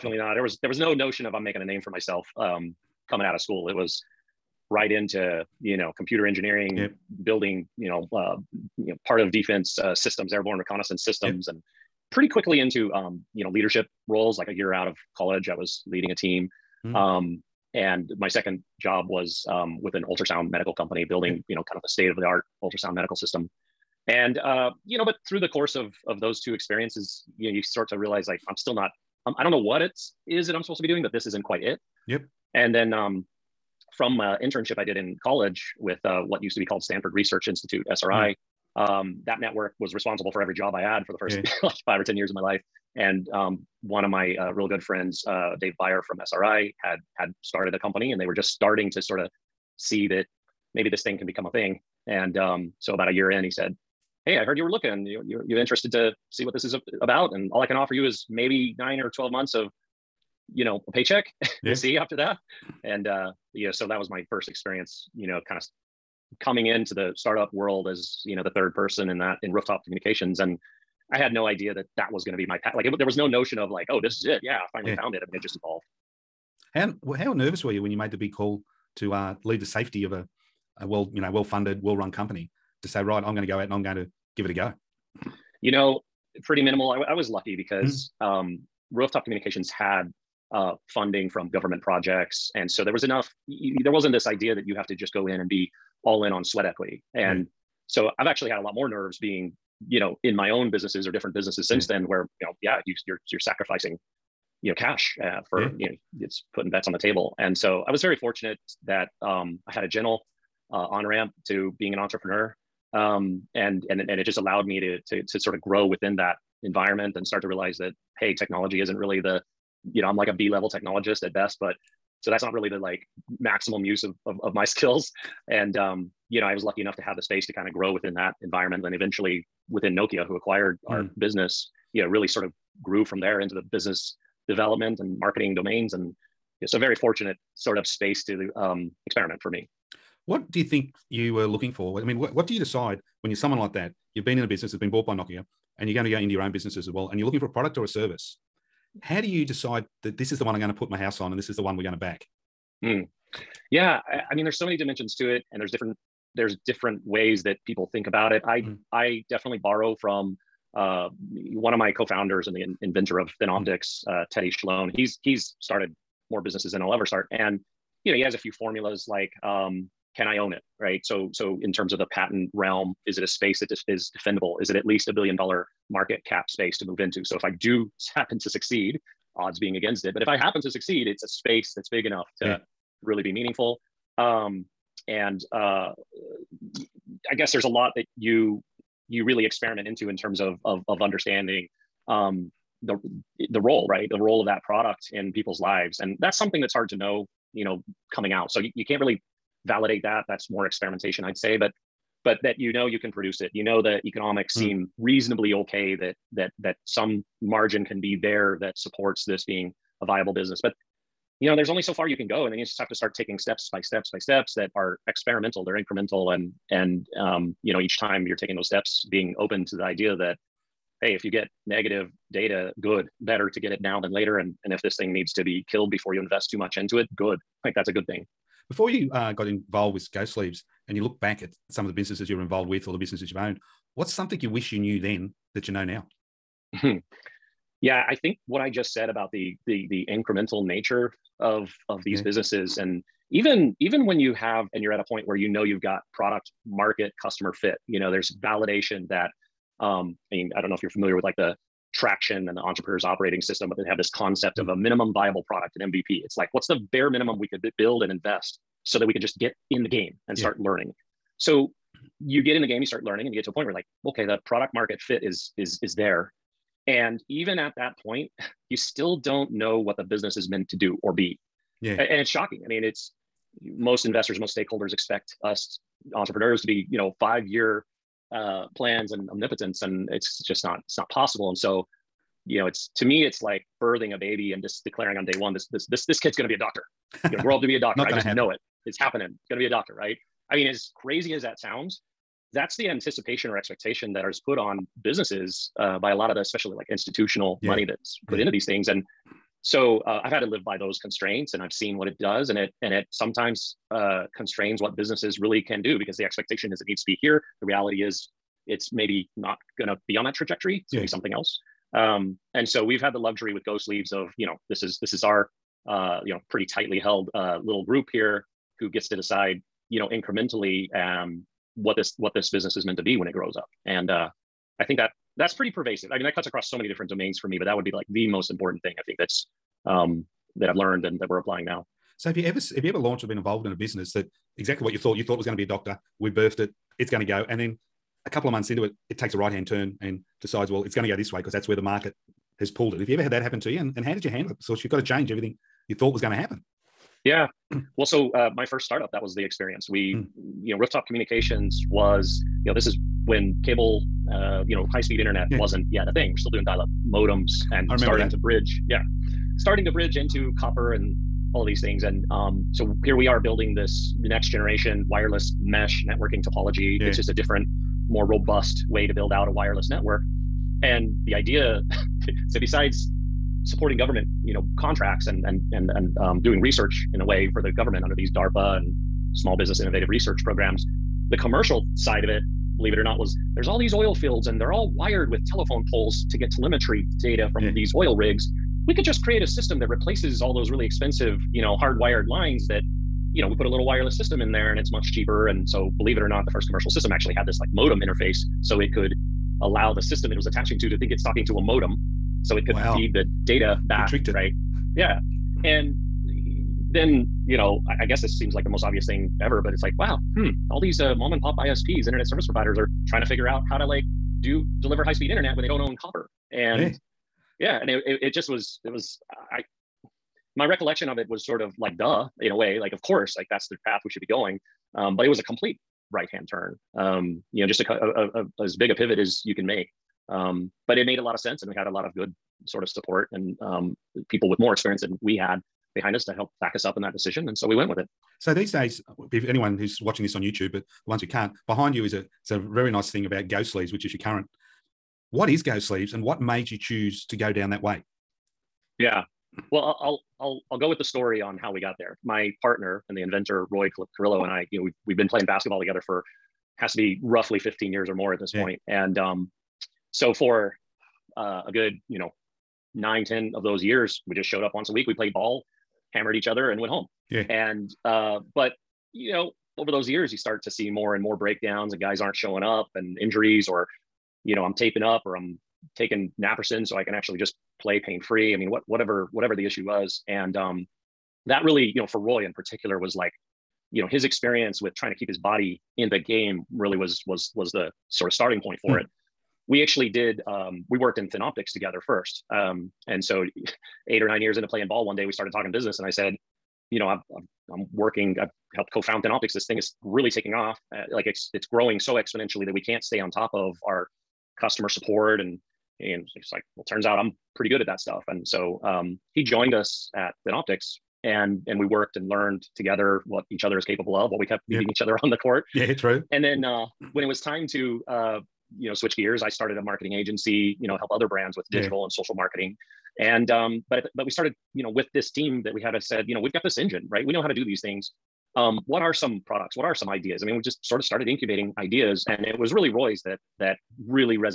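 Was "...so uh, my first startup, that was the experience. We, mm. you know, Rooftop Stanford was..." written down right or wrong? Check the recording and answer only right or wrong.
wrong.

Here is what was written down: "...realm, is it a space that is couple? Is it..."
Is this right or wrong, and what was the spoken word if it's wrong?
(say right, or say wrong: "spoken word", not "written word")
wrong: "defendable", not "couple".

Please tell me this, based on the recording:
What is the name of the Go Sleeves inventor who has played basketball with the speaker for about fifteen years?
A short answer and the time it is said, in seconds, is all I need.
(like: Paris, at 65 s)
Roy Carrillo, at 453 s.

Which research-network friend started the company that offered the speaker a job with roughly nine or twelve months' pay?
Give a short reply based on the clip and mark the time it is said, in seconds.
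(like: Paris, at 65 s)
Dave Byer, at 45 s.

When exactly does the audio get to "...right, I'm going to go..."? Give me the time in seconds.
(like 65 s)
83 s.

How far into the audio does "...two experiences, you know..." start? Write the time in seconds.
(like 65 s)
26 s.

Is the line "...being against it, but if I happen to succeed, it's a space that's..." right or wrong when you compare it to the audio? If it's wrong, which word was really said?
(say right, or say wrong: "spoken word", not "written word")
right.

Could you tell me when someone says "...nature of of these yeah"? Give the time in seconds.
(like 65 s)
240 s.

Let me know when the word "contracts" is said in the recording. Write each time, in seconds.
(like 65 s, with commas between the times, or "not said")
374 s.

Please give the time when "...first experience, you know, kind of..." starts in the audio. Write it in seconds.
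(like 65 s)
64 s.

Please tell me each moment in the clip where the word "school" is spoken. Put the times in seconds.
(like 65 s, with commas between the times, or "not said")
3 s.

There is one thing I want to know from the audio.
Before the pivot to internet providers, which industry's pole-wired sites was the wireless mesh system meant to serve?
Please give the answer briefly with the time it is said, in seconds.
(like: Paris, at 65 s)
Oil fields, at 383 s.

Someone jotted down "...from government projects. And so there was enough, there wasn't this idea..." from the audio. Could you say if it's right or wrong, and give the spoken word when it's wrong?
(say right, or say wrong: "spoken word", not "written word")
right.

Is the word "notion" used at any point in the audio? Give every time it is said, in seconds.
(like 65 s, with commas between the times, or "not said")
0 s, 73 s.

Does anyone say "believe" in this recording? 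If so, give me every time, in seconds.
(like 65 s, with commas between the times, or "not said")
382 s, 395 s.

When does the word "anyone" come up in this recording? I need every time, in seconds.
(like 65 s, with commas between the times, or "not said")
439 s.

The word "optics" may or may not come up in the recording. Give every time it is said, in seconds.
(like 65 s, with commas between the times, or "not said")
163 s, 491 s, 499 s, 510 s.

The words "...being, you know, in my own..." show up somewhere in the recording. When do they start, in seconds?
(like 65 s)
99 s.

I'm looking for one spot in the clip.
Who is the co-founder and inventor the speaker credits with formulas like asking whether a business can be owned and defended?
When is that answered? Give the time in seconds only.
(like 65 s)
164 s.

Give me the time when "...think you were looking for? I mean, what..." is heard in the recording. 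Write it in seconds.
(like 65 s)
140 s.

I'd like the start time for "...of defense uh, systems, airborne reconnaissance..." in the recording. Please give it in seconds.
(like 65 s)
9 s.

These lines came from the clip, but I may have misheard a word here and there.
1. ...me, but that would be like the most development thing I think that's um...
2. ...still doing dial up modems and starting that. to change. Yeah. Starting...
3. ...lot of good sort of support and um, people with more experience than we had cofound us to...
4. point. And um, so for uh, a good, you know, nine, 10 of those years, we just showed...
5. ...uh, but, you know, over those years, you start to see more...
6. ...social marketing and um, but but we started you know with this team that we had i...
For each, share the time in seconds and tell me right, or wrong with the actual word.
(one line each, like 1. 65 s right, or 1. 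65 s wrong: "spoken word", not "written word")
1. 327 s wrong: "important", not "development"
2. 356 s wrong: "bridge", not "change"
3. 431 s wrong: "behind", not "cofound"
4. 458 s right
5. 468 s right
6. 522 s right.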